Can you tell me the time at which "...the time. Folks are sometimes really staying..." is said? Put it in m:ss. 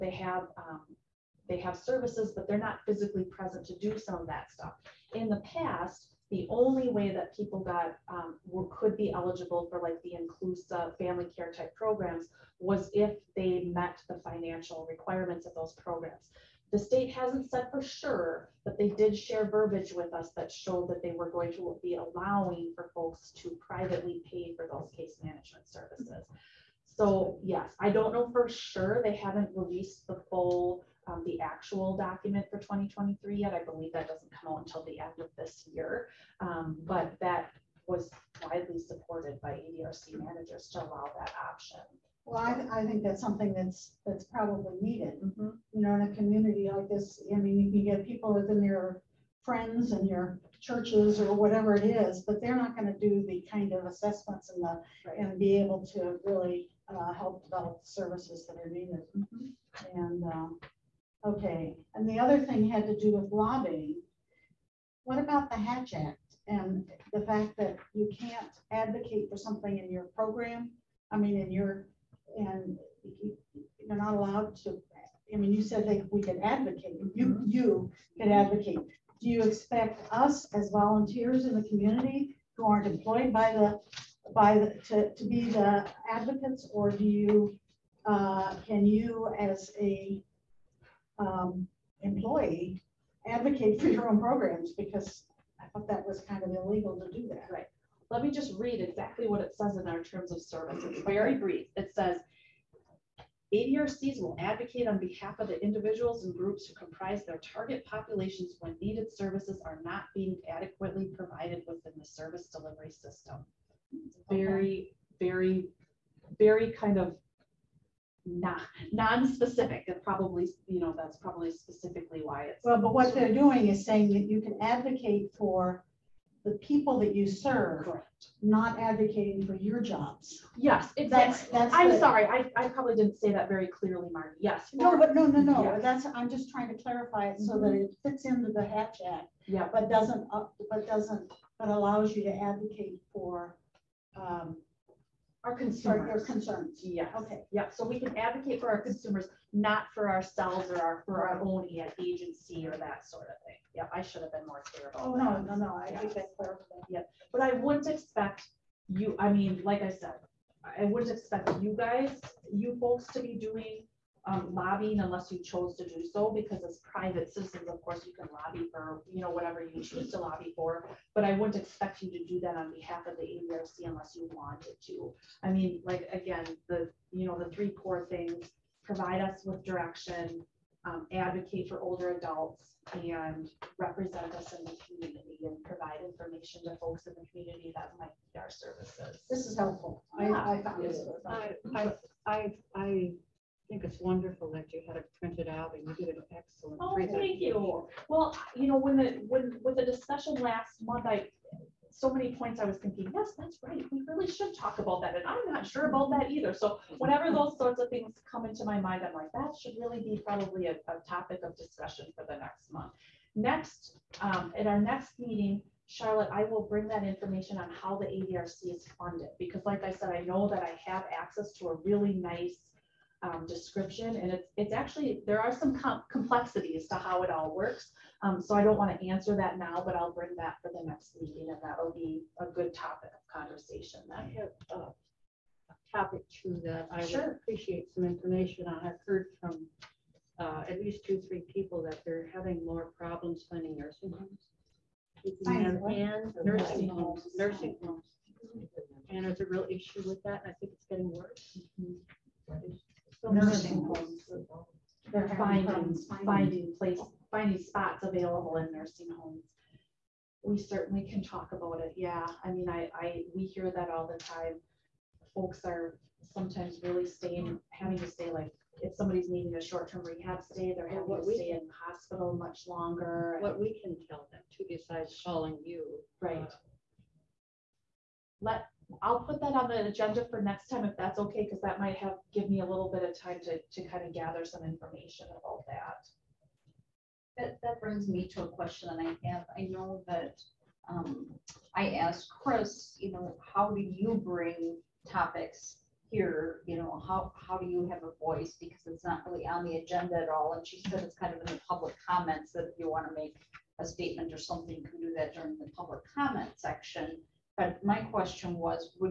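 4:24.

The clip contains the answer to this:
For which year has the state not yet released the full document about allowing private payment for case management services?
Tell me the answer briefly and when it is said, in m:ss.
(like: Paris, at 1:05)
2023, at 0:32.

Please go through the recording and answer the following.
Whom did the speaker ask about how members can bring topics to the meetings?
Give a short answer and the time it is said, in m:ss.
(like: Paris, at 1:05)
Chris, at 4:52.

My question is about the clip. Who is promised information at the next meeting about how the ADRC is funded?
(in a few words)
Charlotte.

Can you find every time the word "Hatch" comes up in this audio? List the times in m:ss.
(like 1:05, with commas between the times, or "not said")
1:05, 2:18.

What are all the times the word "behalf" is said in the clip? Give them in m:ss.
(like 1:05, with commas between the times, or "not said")
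1:44, 2:52.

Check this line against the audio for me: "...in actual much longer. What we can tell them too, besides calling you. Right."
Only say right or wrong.
wrong.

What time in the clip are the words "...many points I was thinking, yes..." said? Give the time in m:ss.
3:22.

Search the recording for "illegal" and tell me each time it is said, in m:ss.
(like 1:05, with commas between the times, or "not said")
1:36.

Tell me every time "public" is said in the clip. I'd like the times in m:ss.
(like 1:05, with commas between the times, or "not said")
5:01, 5:05.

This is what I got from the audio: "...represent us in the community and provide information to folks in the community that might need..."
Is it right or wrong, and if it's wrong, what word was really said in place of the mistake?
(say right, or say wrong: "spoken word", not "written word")
right.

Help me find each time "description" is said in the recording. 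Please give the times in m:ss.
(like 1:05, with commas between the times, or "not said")
3:43.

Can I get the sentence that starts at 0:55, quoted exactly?
and be able to really uh, help develop the services that are needed.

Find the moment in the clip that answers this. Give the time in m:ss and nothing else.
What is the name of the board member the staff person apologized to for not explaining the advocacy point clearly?
2:14.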